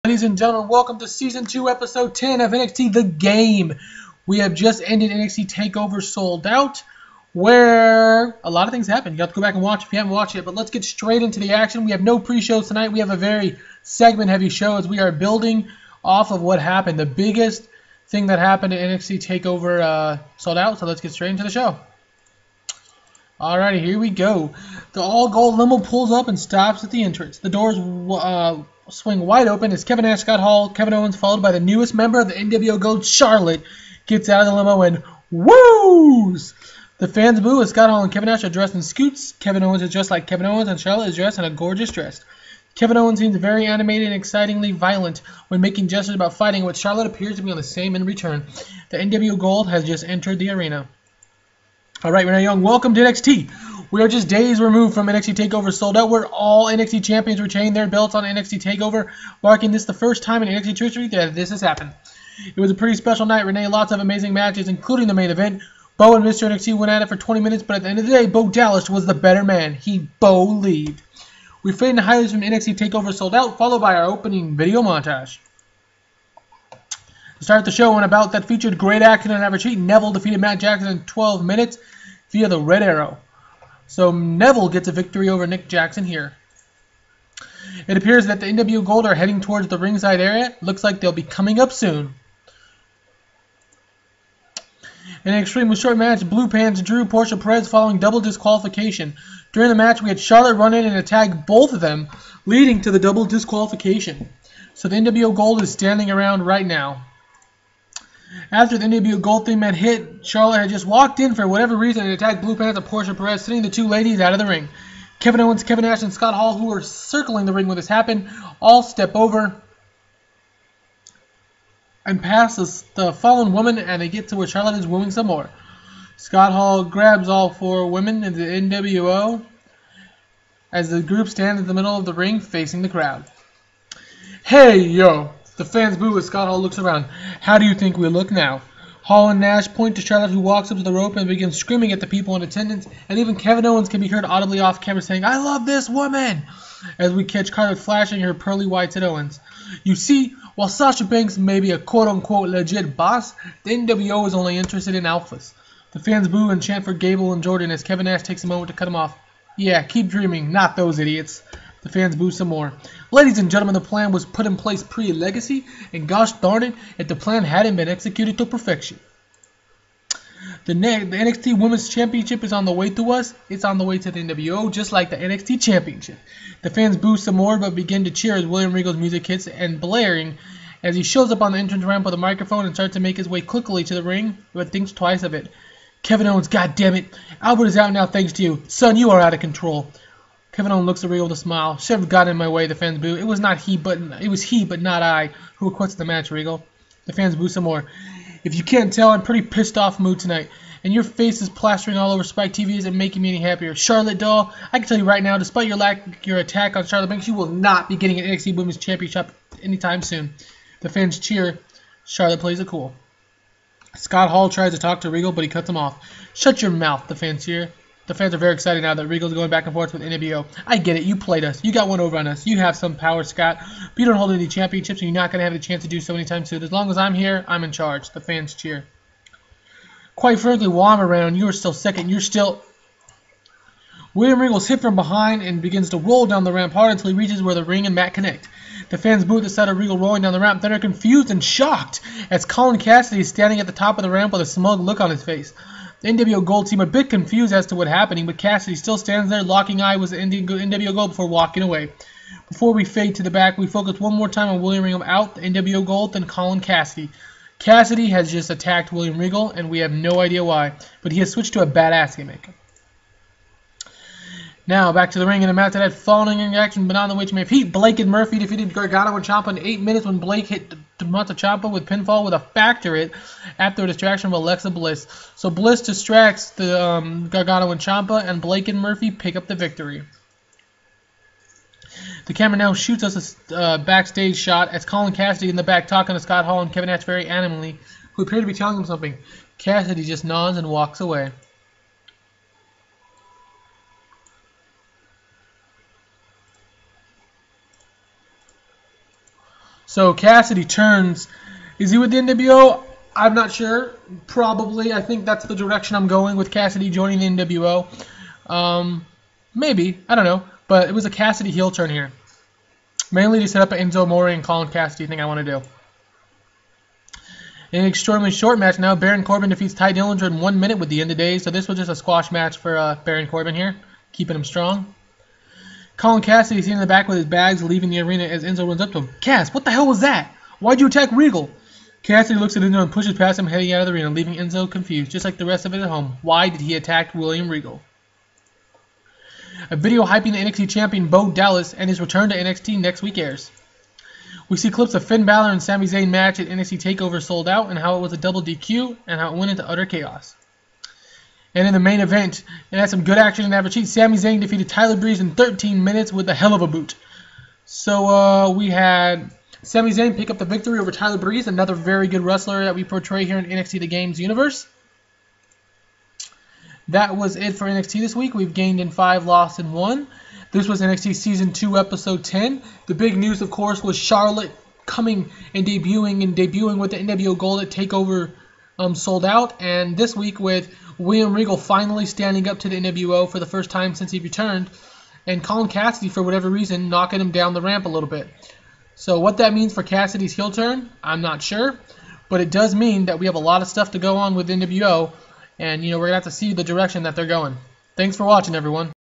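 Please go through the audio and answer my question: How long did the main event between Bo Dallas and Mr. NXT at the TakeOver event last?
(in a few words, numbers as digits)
20 minutes.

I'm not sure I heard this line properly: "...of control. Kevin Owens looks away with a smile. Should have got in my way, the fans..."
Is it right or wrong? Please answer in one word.
right.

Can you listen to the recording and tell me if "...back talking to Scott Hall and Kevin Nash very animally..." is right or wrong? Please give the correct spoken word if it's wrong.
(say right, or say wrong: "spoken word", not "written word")
right.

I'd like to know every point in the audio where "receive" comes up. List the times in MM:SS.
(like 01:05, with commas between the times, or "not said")
not said.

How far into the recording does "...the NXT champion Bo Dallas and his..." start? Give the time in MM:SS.
05:40.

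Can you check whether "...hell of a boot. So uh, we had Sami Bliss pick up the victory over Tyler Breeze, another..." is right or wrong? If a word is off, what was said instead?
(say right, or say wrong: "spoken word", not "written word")
wrong: "Zayn", not "Bliss".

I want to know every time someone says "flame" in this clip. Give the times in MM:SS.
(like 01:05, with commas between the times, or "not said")
not said.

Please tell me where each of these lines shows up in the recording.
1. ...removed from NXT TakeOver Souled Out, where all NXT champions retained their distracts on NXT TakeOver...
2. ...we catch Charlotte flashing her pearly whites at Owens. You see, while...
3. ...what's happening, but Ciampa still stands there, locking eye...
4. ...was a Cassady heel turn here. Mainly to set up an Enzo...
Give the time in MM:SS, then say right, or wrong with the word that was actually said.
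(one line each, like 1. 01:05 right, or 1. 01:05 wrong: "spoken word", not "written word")
1. 00:54 wrong: "belts", not "distracts"
2. 02:27 right
3. 04:07 wrong: "Cassady", not "Ciampa"
4. 05:10 right.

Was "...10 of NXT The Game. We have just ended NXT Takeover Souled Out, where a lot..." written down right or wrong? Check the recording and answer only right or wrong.
right.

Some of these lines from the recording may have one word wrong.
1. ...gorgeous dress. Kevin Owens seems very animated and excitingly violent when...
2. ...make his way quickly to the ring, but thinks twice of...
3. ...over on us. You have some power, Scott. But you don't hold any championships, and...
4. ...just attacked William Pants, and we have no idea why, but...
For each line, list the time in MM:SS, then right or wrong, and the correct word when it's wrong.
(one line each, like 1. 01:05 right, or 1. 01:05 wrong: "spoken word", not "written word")
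1. 00:41 right
2. 03:02 right
3. 03:42 right
4. 04:18 wrong: "Regal", not "Pants".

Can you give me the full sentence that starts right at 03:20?
And your face is plastering all over Spike TV isn't making me any happier.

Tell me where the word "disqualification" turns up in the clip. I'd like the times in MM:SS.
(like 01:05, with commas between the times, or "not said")
01:38, 01:43.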